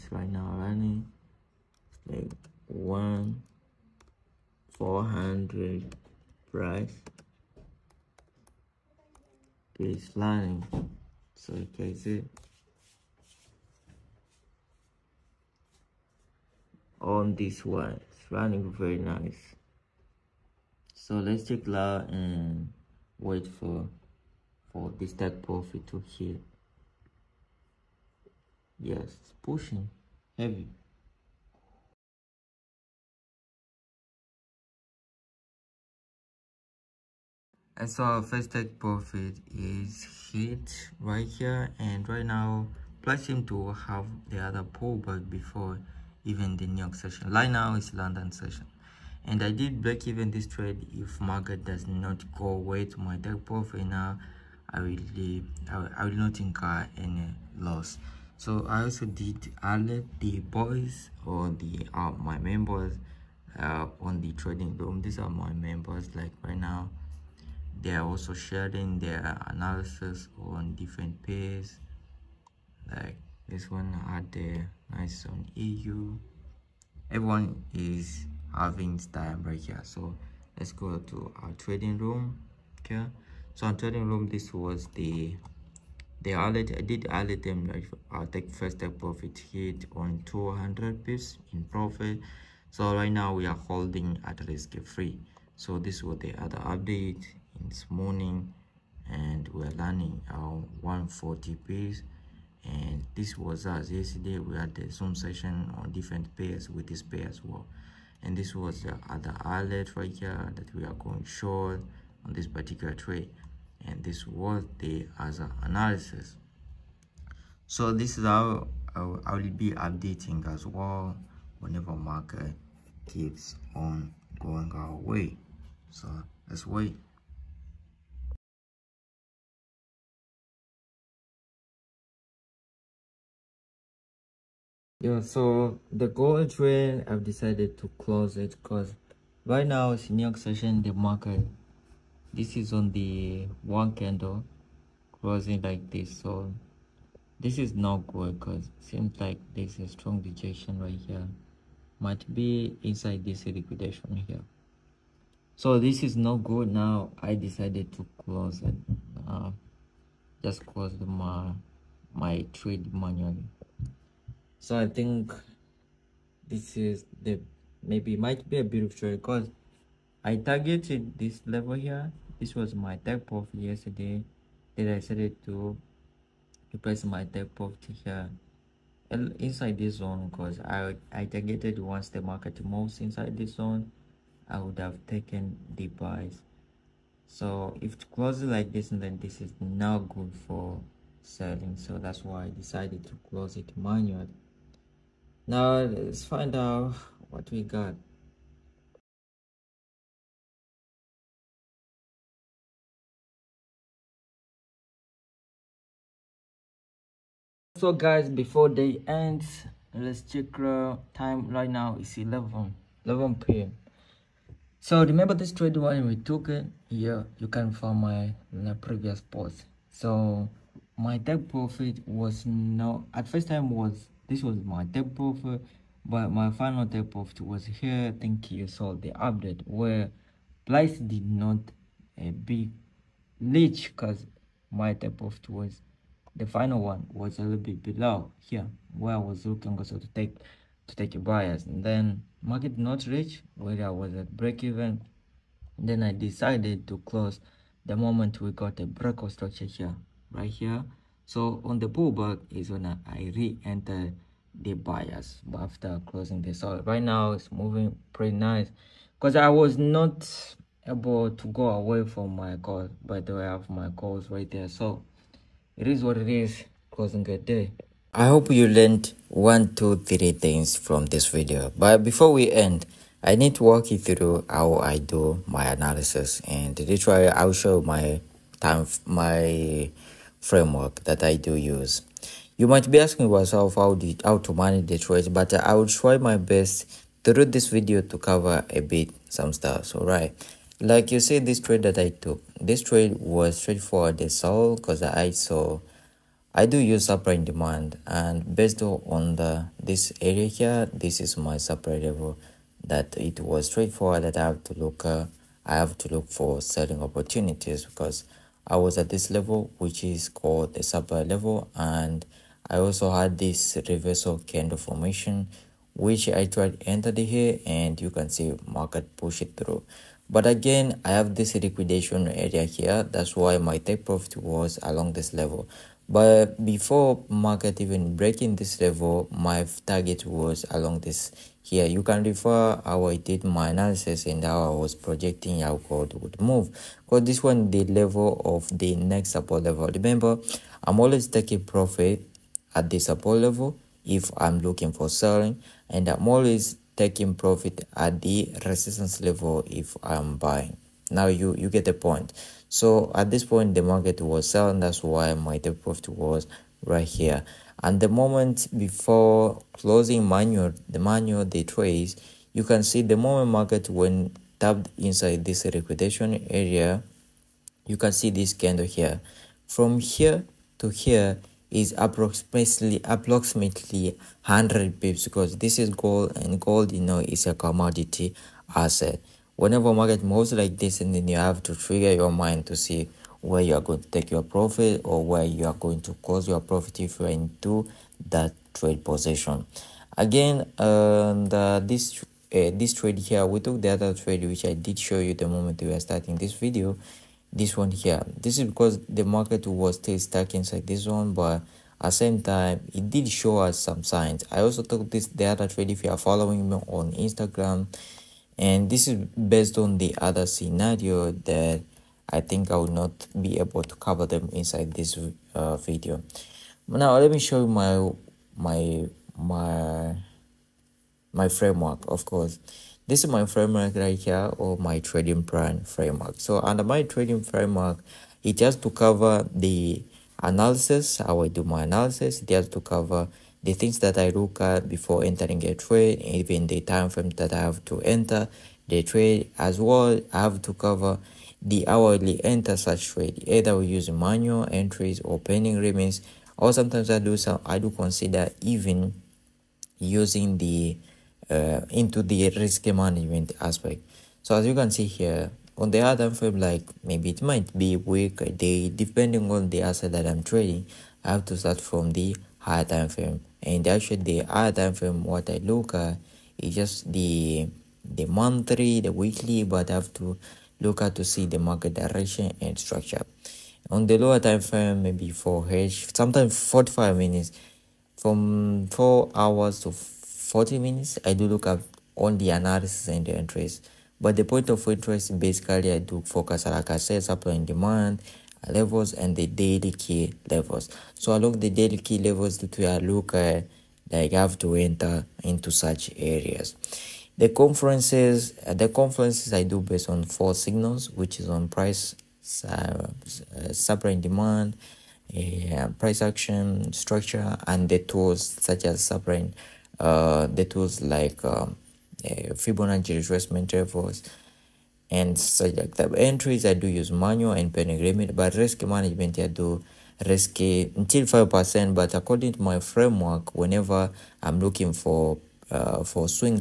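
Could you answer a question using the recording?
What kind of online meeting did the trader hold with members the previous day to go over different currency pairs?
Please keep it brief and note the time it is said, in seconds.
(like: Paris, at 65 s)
Zoom session, at 104 s.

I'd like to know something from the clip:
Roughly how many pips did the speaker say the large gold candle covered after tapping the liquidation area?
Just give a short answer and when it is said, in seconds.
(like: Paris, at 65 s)
100 pips, at 374 s.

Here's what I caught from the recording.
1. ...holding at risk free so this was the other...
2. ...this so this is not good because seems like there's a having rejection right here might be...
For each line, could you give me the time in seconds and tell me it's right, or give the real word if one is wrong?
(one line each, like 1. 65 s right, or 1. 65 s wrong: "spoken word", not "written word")
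1. 93 s right
2. 145 s wrong: "strong", not "having".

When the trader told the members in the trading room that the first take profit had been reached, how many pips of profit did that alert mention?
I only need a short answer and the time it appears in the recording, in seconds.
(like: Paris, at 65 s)
200 pips, at 90 s.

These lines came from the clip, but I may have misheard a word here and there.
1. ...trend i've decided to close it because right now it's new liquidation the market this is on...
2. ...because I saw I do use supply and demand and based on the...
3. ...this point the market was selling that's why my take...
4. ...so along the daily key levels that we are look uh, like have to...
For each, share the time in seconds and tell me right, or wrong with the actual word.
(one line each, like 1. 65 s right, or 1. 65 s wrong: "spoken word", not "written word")
1. 136 s wrong: "session", not "liquidation"
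2. 294 s right
3. 353 s right
4. 491 s right.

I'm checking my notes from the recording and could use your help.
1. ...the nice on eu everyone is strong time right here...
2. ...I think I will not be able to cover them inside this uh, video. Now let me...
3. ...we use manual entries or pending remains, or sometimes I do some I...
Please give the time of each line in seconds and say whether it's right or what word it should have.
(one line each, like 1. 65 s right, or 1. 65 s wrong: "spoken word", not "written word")
1. 74 s wrong: "having", not "strong"
2. 412 s right
3. 443 s right.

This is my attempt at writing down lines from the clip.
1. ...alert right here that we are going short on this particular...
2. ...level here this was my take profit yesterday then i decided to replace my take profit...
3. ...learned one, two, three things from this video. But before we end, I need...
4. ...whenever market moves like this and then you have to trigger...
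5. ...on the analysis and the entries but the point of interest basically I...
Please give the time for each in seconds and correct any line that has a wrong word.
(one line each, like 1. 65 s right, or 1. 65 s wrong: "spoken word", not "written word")
1. 109 s right
2. 171 s right
3. 268 s right
4. 379 s right
5. 482 s right.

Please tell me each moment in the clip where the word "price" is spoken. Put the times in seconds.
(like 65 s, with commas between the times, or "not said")
6 s, 43 s, 501 s, 505 s.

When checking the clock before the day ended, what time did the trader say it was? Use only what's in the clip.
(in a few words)
11 p.m.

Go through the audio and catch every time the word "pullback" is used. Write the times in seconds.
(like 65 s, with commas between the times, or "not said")
44 s, 251 s.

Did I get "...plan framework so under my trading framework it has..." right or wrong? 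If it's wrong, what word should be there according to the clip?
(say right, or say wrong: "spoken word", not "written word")
right.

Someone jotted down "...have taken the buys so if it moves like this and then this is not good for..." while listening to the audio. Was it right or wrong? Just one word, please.
wrong.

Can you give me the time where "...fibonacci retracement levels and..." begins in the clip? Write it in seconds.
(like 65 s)
512 s.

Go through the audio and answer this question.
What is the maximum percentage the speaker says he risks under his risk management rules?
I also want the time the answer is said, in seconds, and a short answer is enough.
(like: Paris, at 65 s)
5 percent, at 521 s.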